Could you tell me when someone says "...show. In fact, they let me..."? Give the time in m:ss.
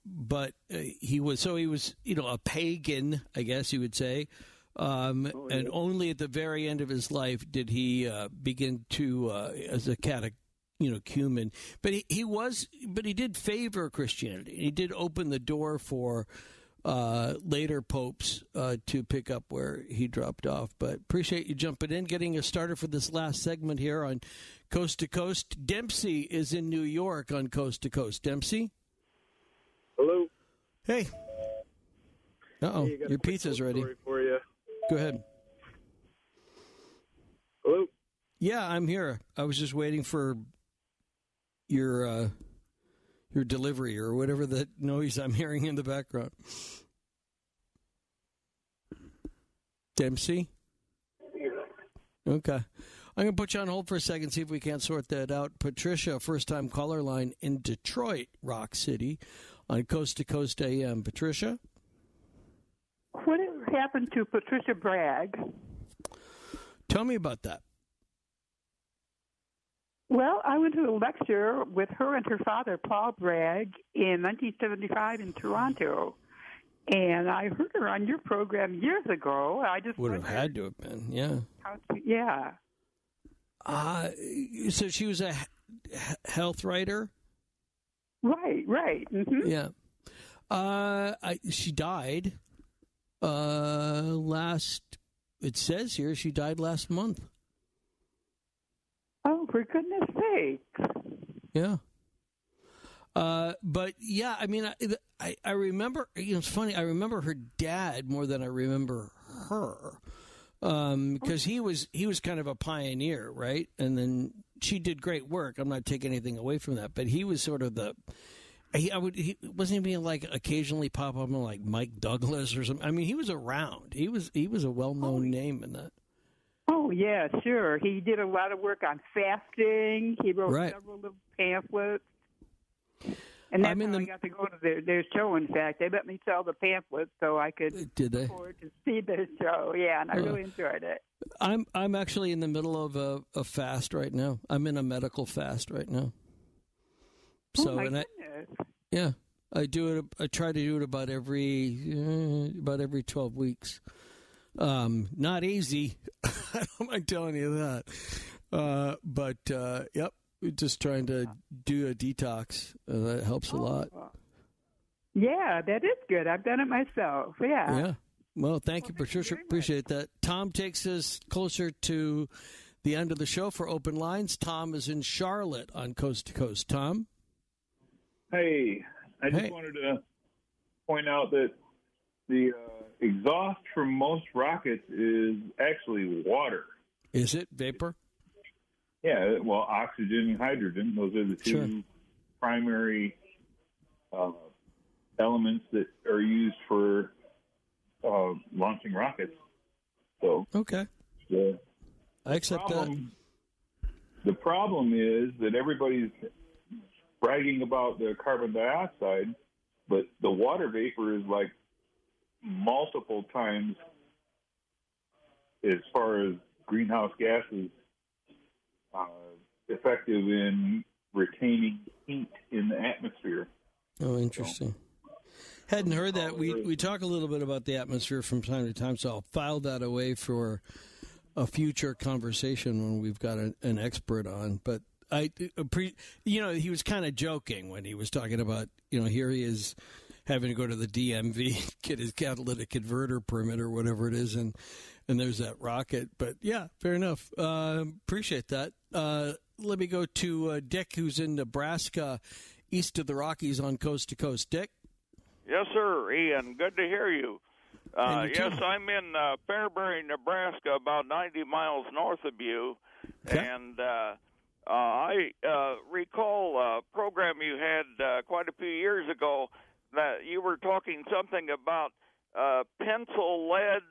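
2:15.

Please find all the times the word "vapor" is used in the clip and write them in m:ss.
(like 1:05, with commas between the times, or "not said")
3:07, 3:30.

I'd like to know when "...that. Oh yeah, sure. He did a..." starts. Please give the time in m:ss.
2:05.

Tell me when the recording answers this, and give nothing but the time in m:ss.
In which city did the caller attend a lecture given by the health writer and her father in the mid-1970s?
1:15.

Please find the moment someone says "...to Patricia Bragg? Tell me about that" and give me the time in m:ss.
1:04.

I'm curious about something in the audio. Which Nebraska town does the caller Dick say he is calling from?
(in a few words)
Fairbury.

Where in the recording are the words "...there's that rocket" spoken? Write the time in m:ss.
4:05.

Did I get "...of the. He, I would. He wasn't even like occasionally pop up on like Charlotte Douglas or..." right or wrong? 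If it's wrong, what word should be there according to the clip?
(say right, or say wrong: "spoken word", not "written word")
wrong: "Mike", not "Charlotte".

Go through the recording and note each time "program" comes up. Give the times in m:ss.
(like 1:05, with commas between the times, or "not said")
1:18, 4:26.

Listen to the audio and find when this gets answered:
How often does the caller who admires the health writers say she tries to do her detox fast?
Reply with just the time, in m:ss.
2:32.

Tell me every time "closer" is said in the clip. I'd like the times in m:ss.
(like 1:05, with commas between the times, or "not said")
2:51.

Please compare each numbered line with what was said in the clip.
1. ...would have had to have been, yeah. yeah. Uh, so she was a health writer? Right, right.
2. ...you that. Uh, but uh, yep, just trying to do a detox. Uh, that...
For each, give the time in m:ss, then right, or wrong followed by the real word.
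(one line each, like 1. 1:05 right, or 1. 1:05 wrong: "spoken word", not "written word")
1. 1:19 right
2. 2:37 right.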